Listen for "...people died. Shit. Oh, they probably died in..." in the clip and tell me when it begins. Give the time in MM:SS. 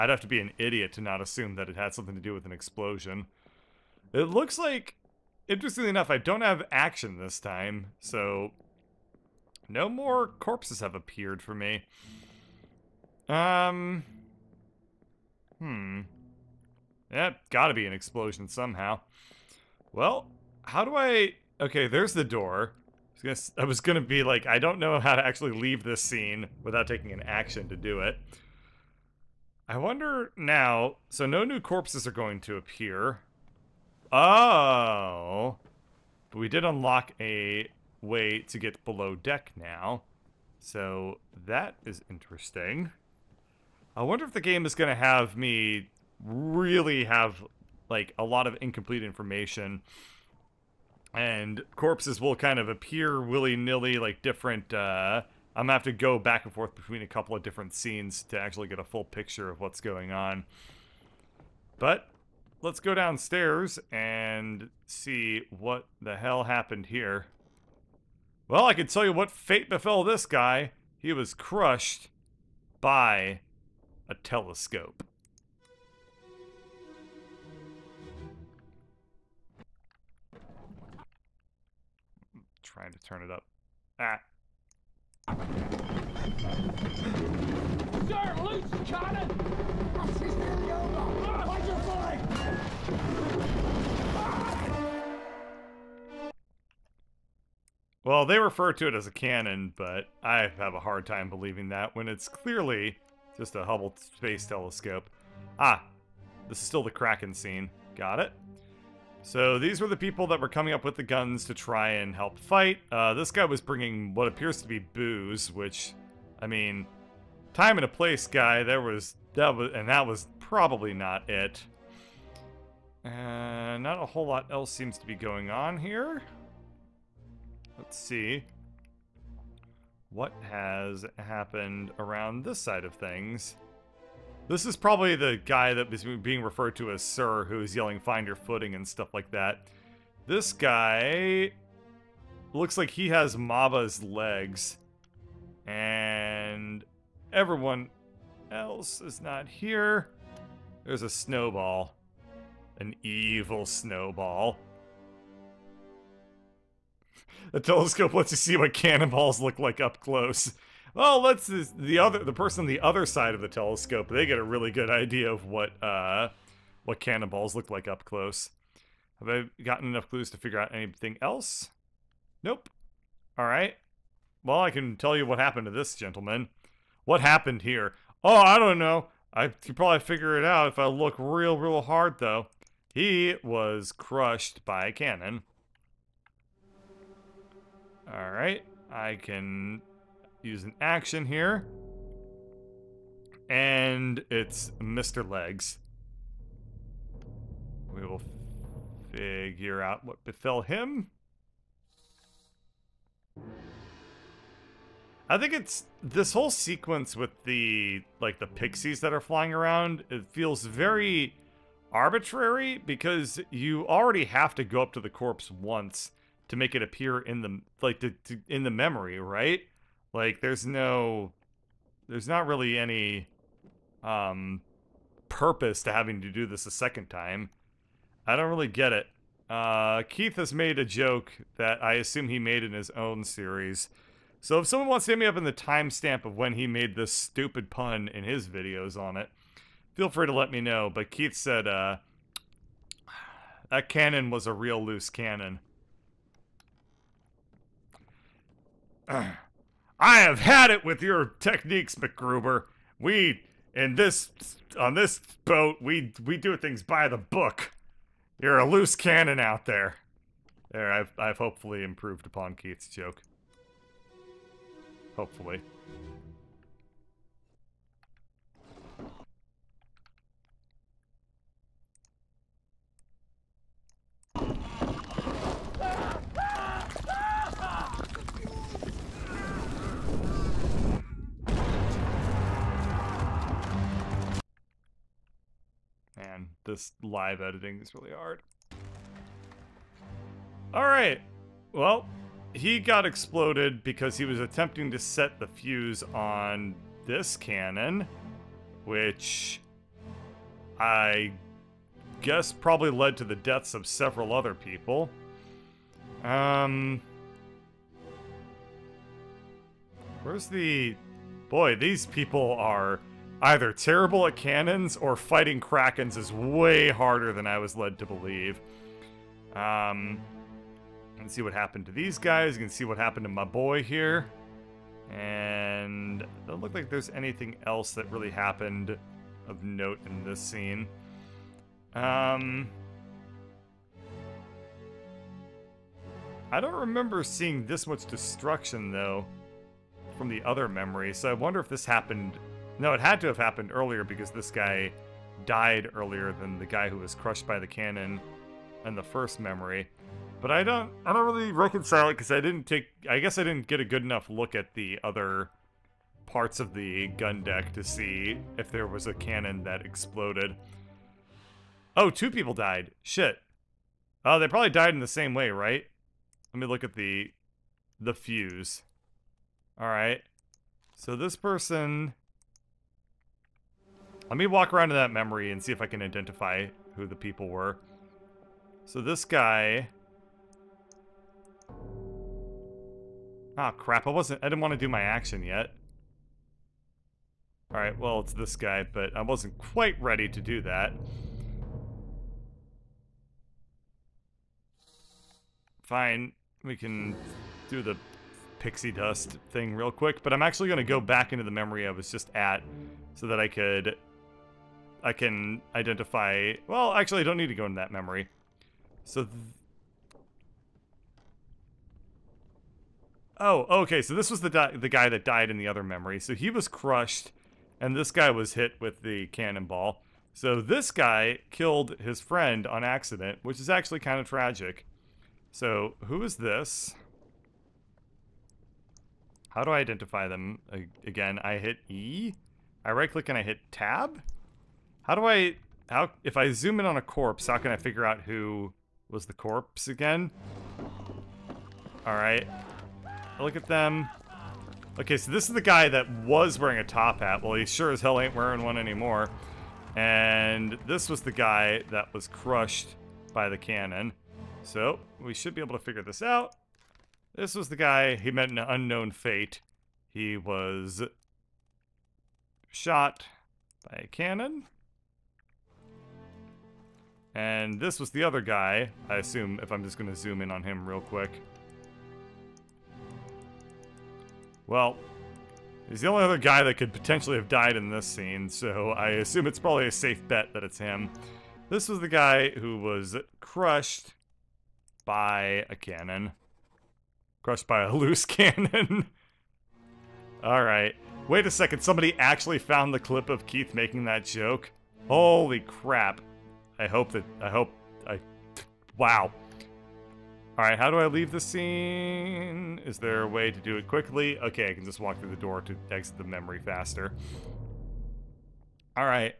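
06:02.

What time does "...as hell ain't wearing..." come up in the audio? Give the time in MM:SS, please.
07:27.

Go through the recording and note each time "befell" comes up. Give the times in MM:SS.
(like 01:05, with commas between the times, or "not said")
01:09, 03:20.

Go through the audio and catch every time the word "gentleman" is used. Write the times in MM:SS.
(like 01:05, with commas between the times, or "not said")
02:55.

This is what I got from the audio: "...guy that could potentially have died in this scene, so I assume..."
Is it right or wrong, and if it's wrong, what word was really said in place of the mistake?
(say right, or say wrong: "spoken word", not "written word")
right.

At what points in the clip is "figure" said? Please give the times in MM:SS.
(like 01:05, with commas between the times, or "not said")
02:50, 02:59, 03:19, 07:17, 07:35.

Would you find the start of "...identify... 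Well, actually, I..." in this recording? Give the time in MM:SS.
06:45.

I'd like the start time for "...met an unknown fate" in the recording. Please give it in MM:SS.
07:38.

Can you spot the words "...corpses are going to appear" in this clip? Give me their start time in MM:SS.
00:31.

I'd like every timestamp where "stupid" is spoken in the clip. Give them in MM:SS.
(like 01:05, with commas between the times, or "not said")
03:57.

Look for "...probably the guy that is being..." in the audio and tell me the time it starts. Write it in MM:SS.
02:14.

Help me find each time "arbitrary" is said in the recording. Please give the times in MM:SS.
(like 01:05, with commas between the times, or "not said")
03:31.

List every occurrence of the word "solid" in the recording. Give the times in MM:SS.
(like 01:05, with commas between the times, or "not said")
not said.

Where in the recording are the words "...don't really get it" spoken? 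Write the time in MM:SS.
03:48.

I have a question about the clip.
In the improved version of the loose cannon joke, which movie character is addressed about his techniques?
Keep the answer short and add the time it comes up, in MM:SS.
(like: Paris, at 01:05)
MacGruber, at 04:11.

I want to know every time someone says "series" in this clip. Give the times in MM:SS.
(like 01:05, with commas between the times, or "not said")
03:53.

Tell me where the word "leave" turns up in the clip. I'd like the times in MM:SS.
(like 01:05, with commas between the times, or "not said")
00:25, 08:21.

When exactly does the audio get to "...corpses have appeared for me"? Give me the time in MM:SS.
00:10.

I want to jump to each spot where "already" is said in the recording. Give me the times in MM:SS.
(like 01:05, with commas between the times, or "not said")
03:33.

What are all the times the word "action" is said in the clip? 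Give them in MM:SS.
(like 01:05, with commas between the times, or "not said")
00:06, 00:27, 03:10, 06:25.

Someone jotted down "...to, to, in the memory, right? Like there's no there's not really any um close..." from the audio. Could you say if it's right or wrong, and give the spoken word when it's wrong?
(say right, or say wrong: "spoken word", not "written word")
wrong: "purpose", not "close".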